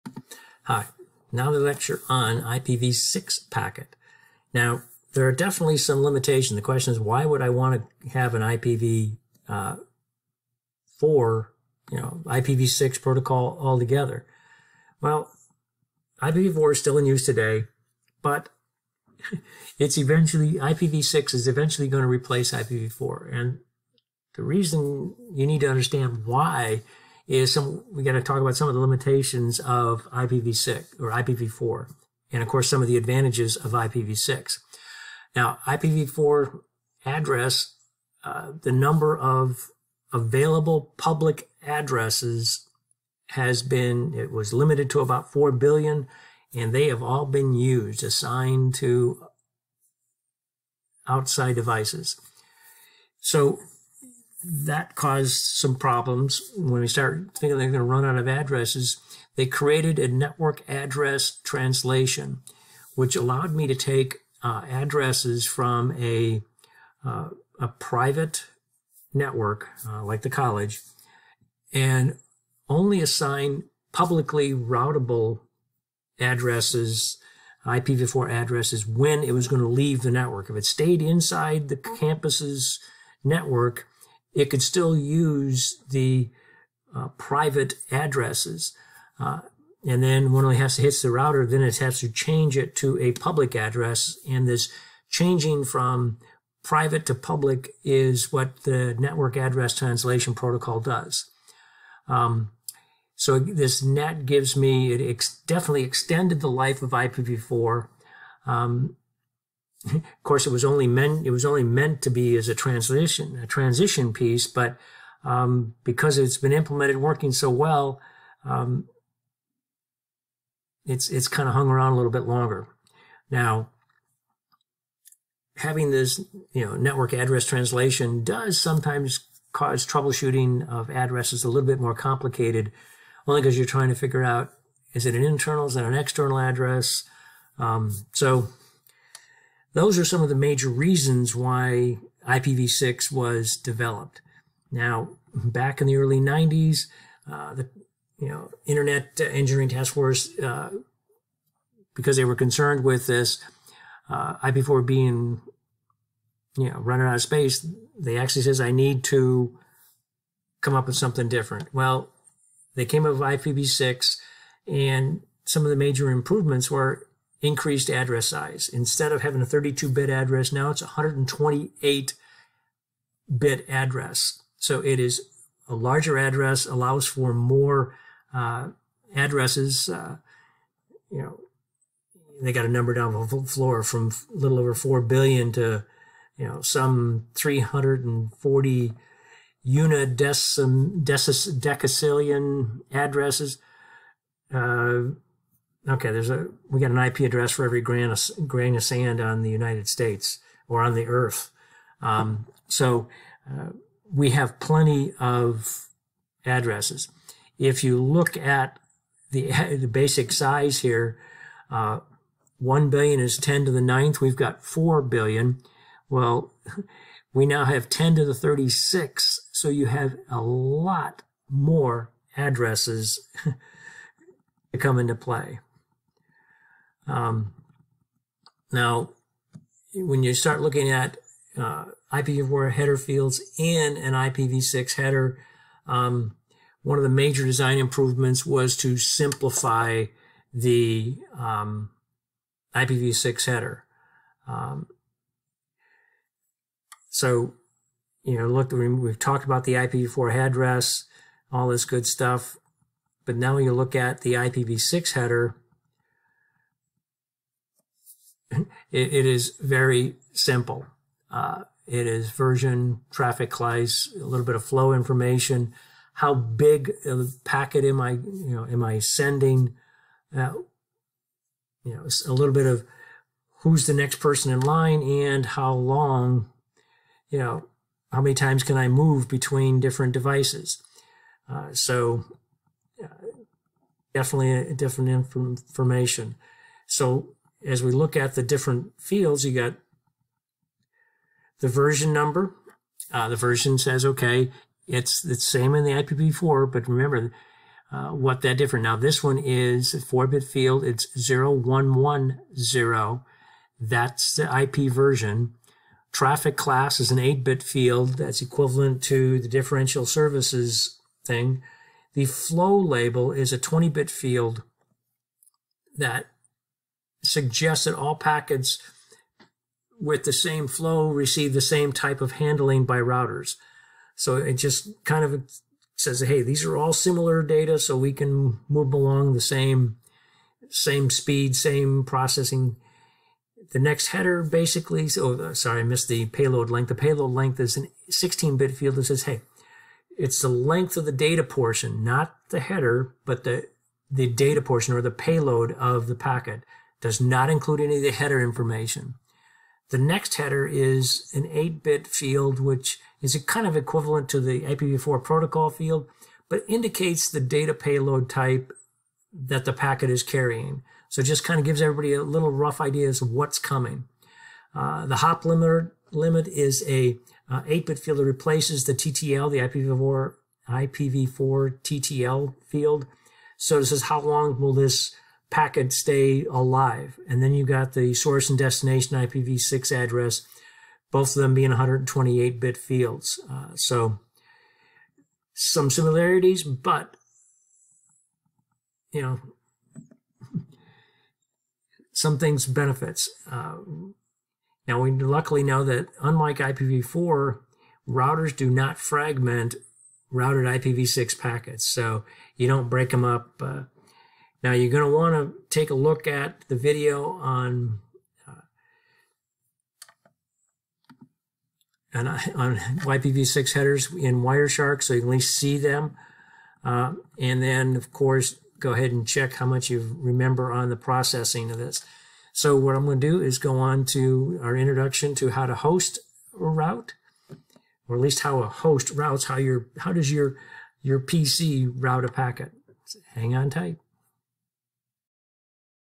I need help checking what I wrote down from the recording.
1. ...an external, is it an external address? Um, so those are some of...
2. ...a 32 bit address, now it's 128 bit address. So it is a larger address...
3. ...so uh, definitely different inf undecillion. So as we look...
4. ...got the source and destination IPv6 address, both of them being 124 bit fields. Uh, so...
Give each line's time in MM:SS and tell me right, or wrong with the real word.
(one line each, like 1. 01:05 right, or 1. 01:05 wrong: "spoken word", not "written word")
1. 02:15 wrong: "internal", not "external"
2. 02:49 right
3. 04:41 wrong: "information", not "undecillion"
4. 06:17 wrong: "128", not "124".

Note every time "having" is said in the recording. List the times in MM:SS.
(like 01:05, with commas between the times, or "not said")
02:05, 02:49.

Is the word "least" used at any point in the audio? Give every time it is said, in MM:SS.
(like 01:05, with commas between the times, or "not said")
06:55, 07:08.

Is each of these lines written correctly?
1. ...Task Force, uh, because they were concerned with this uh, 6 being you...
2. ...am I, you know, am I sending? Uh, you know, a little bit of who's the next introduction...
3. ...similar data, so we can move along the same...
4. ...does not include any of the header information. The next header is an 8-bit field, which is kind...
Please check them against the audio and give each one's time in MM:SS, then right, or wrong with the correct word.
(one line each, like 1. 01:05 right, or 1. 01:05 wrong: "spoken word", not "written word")
1. 02:29 wrong: "4", not "6"
2. 04:27 wrong: "person", not "introduction"
3. 05:26 right
4. 05:47 right.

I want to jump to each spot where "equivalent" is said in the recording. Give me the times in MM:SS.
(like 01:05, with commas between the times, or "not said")
05:08, 05:53.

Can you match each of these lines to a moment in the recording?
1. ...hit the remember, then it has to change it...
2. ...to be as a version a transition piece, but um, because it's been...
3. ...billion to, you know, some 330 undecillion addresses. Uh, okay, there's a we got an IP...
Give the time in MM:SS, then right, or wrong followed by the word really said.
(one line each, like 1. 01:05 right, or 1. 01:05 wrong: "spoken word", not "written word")
1. 01:30 wrong: "router", not "remember"
2. 01:52 wrong: "transition", not "version"
3. 03:05 wrong: "340", not "330".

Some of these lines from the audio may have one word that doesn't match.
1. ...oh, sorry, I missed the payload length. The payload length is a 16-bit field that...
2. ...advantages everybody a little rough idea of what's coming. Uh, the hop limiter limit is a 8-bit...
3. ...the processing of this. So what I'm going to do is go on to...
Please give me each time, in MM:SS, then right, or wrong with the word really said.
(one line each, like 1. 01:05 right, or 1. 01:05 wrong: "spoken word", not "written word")
1. 05:35 right
2. 06:01 wrong: "gives", not "advantages"
3. 07:00 right.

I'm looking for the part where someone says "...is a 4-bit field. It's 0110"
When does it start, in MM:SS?
04:59.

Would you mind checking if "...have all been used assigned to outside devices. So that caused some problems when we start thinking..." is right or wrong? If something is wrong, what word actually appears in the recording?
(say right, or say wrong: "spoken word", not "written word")
right.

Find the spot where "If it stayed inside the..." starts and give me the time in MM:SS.
01:20.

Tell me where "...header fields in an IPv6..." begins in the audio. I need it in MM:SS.
03:52.